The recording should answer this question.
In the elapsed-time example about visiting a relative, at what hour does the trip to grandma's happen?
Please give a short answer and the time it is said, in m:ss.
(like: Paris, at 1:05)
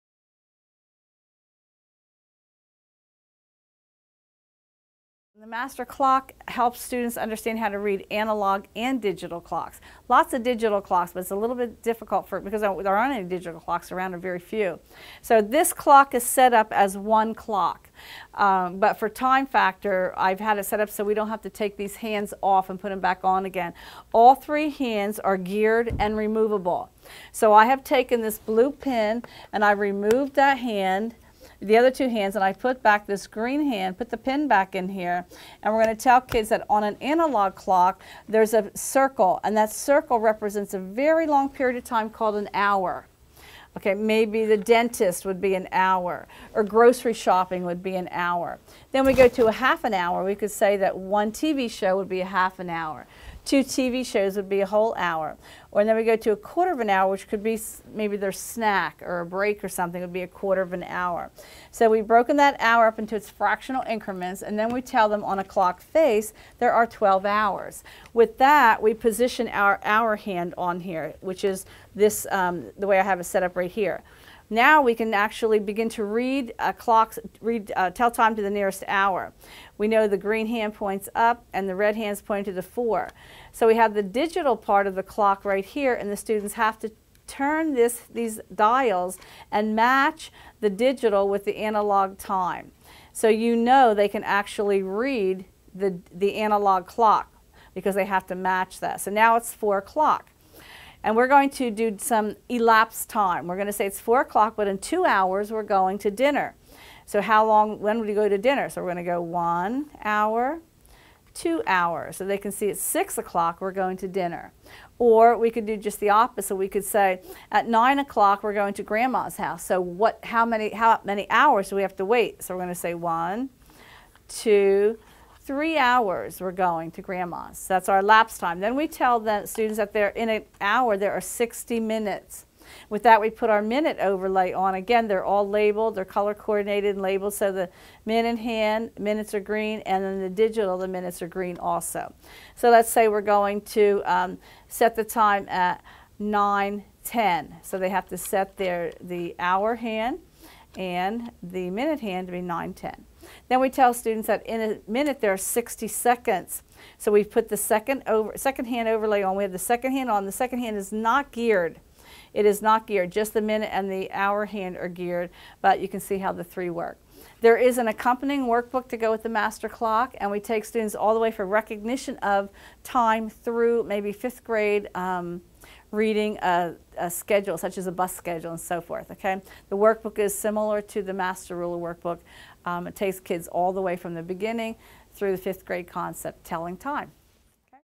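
9 o'clock, at 1:57.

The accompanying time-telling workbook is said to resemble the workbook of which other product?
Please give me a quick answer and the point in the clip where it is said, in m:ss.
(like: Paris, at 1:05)
Master Ruler, at 3:01.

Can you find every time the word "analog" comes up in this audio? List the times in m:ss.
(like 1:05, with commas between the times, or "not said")
0:08, 0:37, 1:31, 1:36.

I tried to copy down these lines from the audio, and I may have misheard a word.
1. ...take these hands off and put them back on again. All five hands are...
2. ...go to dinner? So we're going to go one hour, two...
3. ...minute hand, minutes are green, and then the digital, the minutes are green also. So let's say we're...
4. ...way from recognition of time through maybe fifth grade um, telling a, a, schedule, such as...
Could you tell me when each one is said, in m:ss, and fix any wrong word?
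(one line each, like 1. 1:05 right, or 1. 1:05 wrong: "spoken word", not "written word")
1. 0:21 wrong: "three", not "five"
2. 1:48 right
3. 2:18 right
4. 2:51 wrong: "reading", not "telling".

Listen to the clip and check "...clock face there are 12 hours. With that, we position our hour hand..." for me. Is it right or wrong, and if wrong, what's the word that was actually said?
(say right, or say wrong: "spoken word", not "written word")
right.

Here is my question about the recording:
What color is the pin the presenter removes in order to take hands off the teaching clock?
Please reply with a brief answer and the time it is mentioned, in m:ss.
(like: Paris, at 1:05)
blue, at 0:28.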